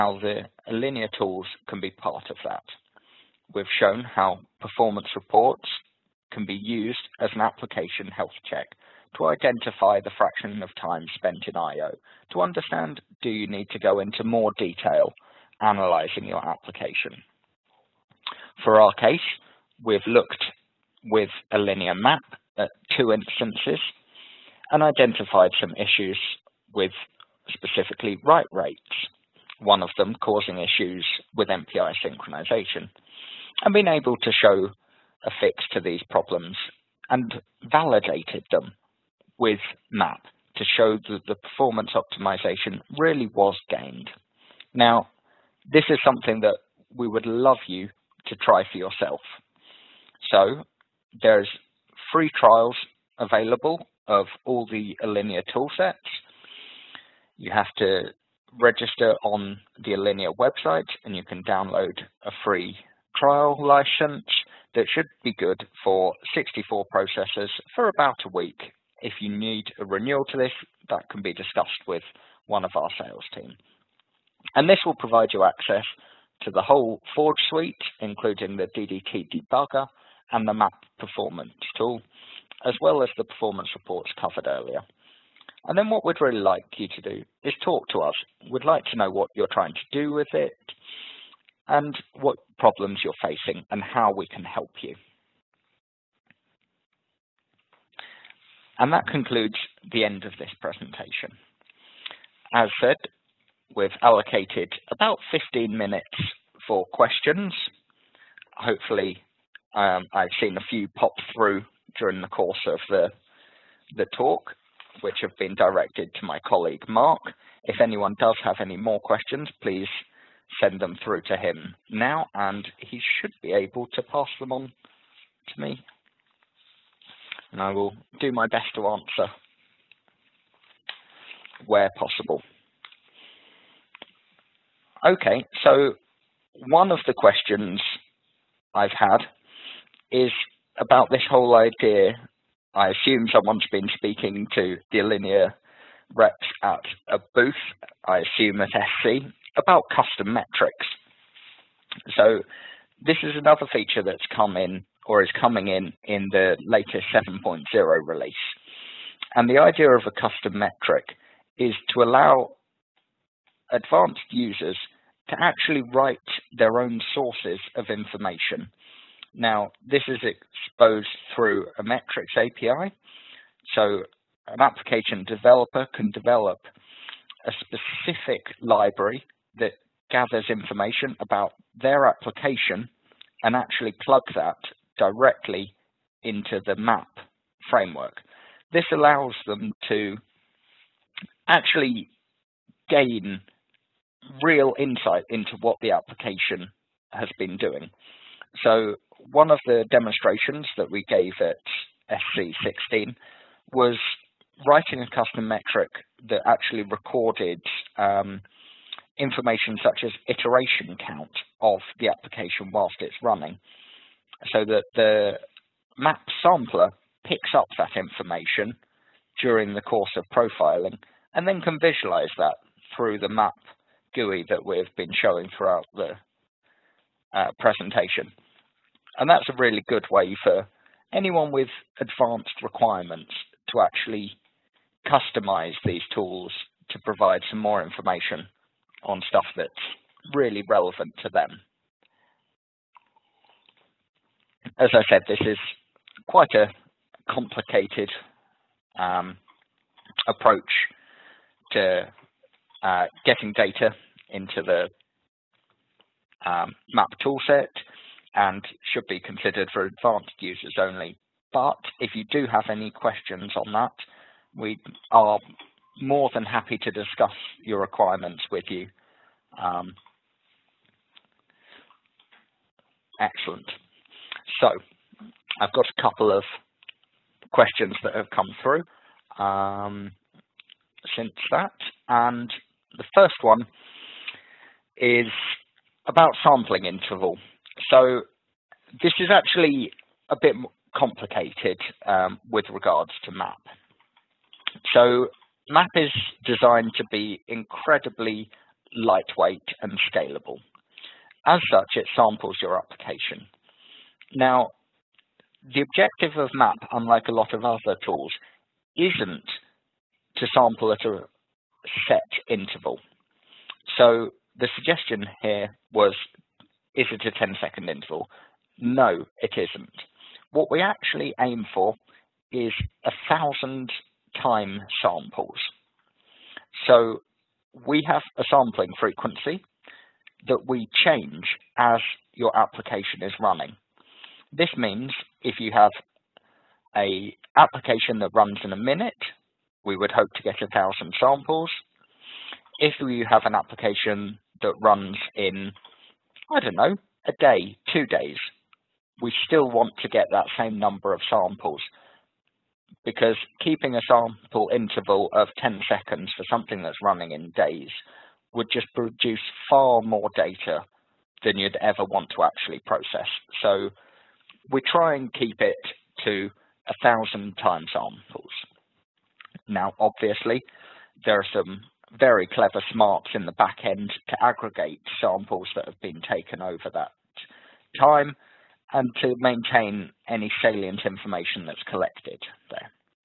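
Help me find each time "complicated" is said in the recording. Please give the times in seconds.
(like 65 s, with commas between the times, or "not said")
247 s, 290 s.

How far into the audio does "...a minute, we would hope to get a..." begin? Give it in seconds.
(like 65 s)
338 s.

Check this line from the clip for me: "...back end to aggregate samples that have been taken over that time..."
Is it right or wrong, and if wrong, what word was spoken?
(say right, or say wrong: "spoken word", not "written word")
right.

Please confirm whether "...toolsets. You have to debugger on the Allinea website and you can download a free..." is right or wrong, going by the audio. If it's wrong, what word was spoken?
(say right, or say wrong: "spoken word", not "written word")
wrong: "register", not "debugger".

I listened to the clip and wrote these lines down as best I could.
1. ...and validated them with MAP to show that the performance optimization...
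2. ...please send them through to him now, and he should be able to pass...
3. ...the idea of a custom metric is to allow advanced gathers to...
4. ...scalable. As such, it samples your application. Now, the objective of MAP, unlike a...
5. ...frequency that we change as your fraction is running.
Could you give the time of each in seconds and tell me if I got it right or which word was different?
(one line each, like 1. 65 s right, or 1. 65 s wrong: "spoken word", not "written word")
1. 37 s right
2. 119 s right
3. 159 s wrong: "users", not "gathers"
4. 300 s right
5. 328 s wrong: "application", not "fraction".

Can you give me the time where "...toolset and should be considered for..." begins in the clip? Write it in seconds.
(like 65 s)
257 s.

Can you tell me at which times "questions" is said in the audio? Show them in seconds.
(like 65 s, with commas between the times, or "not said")
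106 s, 119 s, 137 s, 262 s, 277 s.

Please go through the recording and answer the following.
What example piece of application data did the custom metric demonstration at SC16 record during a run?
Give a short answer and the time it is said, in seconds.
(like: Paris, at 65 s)
iteration count, at 210 s.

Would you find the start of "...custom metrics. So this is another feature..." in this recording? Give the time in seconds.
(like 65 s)
149 s.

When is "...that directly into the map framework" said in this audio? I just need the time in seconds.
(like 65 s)
184 s.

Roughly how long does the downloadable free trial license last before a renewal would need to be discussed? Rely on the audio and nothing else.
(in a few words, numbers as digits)
about a week.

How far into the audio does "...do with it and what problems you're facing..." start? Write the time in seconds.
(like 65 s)
89 s.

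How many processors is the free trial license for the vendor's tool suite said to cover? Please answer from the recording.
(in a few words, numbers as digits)
64.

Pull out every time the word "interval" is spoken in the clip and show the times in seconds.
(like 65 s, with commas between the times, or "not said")
286 s, 312 s, 317 s, 354 s.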